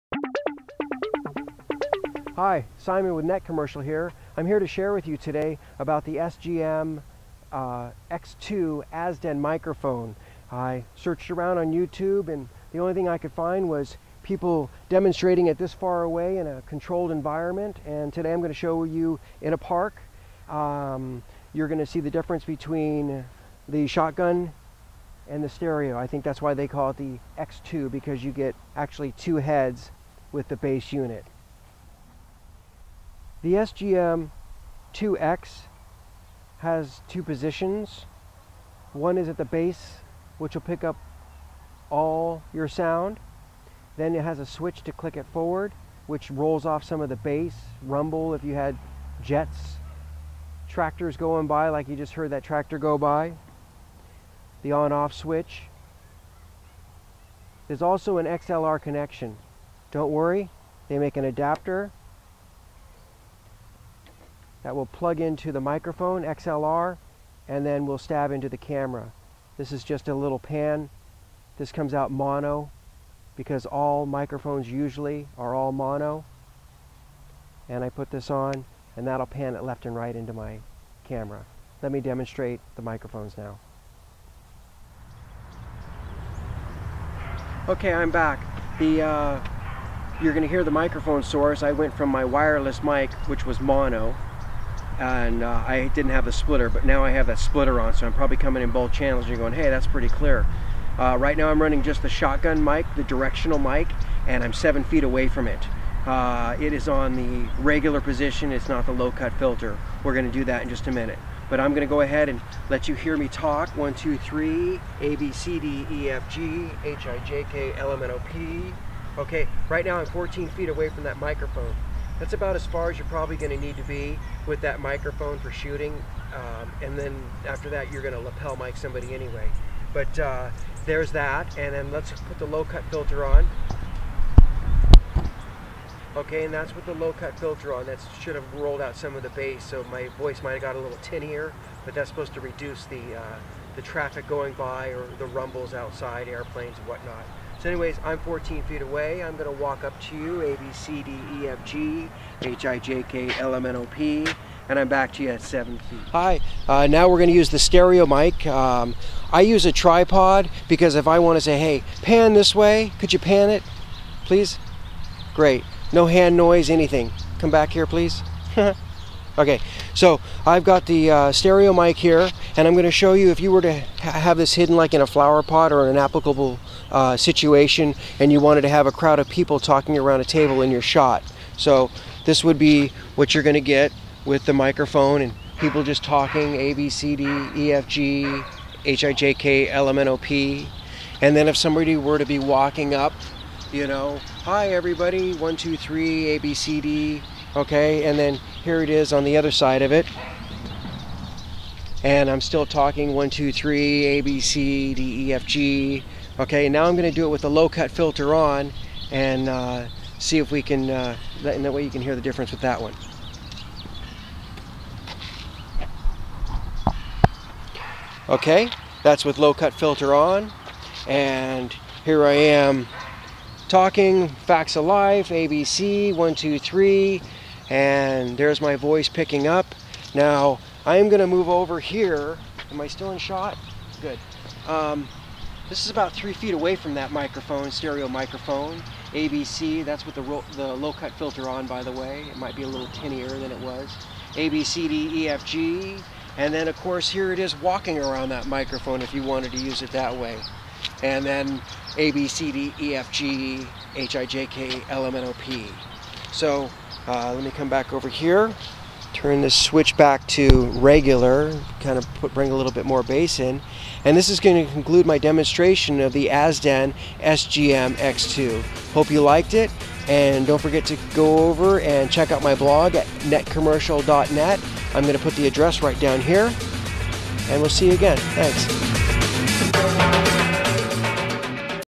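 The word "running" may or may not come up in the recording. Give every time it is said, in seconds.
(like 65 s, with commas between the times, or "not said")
101 s.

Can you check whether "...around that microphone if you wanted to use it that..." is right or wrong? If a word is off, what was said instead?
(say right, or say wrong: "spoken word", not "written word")
right.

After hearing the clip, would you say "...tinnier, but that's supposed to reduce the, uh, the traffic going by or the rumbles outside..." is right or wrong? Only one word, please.
right.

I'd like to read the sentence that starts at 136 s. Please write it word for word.
Okay, and that's with the low cut filter on.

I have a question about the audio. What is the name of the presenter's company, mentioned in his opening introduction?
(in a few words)
Net Commercial.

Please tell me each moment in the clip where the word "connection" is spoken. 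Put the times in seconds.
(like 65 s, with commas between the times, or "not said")
58 s.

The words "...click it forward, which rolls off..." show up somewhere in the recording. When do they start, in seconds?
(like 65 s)
44 s.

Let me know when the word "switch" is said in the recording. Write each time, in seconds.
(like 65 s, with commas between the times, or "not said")
44 s, 55 s, 259 s.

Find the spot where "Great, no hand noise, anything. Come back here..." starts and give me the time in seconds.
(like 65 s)
165 s.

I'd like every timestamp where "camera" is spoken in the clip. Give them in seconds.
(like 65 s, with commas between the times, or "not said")
68 s, 81 s.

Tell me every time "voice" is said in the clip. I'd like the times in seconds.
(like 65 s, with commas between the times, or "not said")
140 s, 228 s.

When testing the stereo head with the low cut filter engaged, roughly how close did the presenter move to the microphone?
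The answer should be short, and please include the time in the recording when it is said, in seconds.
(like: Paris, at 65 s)
3 feet, at 236 s.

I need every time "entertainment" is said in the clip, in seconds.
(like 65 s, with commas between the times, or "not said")
not said.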